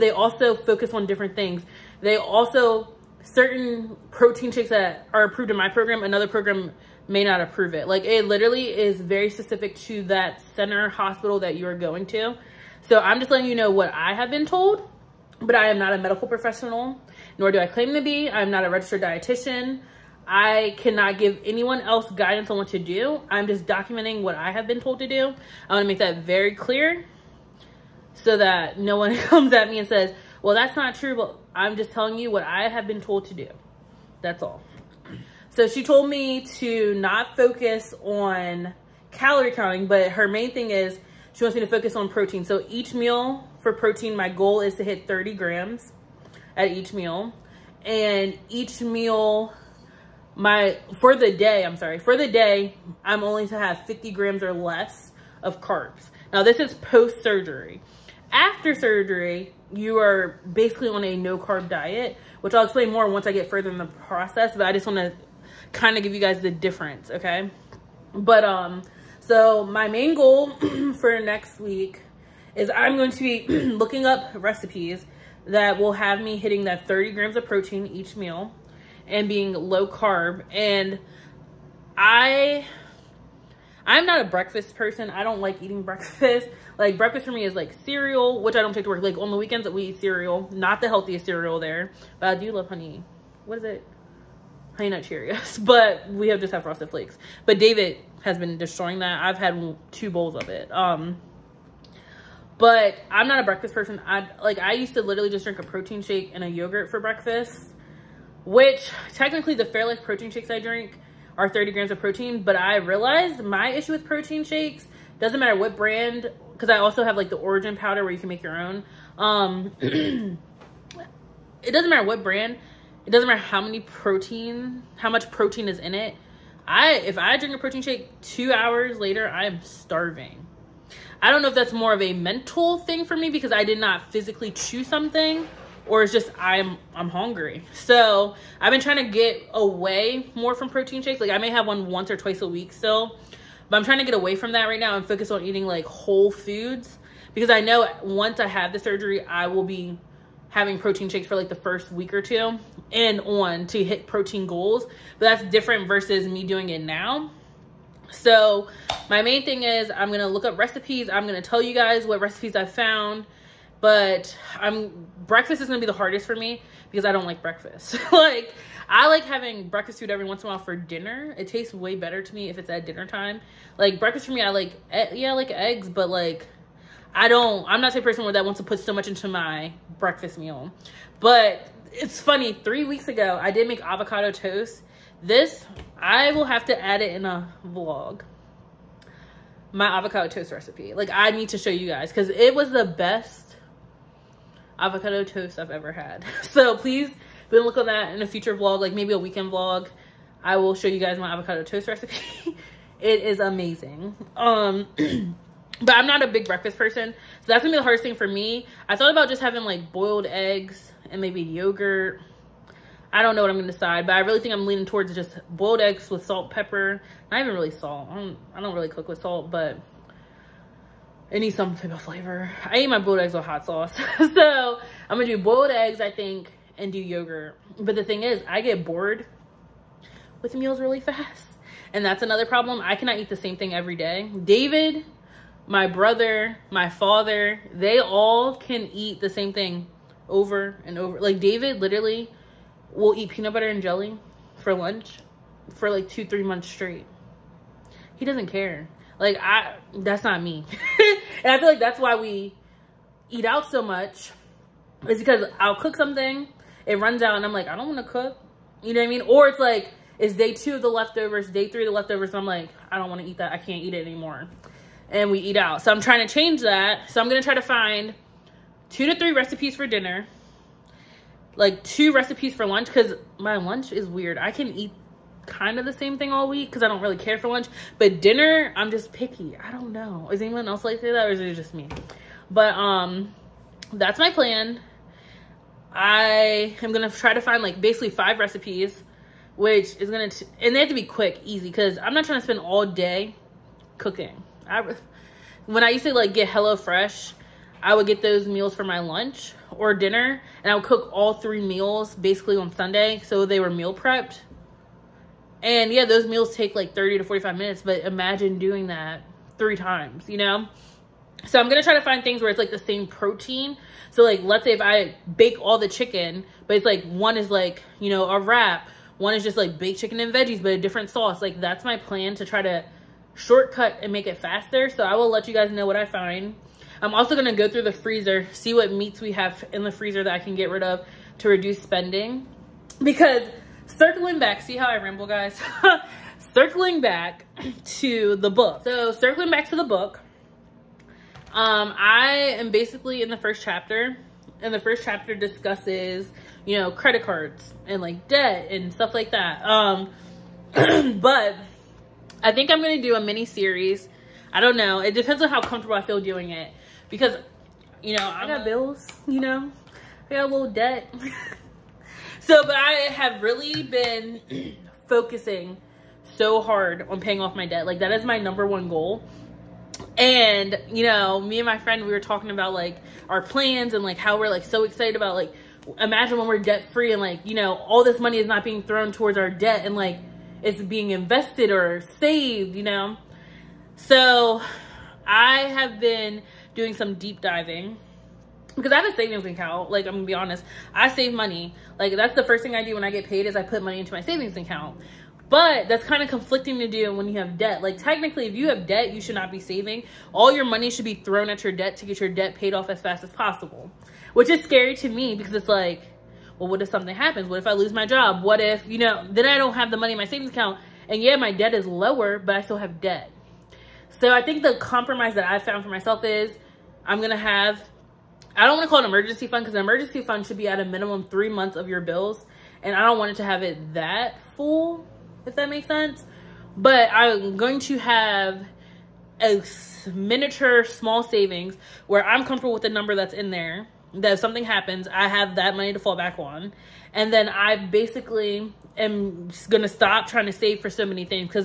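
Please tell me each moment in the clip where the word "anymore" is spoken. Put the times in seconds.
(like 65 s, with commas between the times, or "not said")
264 s.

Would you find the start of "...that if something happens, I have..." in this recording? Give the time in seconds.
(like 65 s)
434 s.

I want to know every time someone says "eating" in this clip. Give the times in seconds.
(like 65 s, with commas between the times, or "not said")
85 s, 145 s.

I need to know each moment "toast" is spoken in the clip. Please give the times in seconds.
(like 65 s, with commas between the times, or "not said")
184 s, 190 s, 195 s, 201 s.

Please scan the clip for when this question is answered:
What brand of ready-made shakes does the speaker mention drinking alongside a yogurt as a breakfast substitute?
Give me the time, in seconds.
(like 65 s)
109 s.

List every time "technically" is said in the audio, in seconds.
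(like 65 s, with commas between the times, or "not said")
109 s, 397 s.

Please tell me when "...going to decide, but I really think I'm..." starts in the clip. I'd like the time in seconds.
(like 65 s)
213 s.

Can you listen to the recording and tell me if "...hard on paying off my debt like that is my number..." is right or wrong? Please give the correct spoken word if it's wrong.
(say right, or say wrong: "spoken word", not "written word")
right.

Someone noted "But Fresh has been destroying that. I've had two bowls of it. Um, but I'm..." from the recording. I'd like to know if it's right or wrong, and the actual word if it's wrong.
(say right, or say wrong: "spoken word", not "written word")
wrong: "David", not "Fresh".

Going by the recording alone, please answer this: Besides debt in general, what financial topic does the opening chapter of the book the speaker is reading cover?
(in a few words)
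Credit cards.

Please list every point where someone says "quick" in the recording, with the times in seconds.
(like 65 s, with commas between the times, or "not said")
291 s.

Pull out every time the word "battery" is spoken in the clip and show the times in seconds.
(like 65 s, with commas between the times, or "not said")
not said.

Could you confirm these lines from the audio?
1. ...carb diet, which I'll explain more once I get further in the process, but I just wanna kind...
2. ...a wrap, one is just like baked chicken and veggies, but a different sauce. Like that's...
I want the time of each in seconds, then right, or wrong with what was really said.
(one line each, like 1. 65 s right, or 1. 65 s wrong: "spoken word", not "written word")
1. 61 s right
2. 318 s right.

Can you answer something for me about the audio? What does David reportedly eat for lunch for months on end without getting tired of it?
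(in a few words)
Peanut butter and jelly.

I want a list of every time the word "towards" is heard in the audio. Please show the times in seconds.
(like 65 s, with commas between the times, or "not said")
214 s, 379 s.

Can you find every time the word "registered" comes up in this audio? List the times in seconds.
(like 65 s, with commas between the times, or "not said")
18 s.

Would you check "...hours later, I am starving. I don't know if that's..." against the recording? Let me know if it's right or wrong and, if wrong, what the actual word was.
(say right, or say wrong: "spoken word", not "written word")
right.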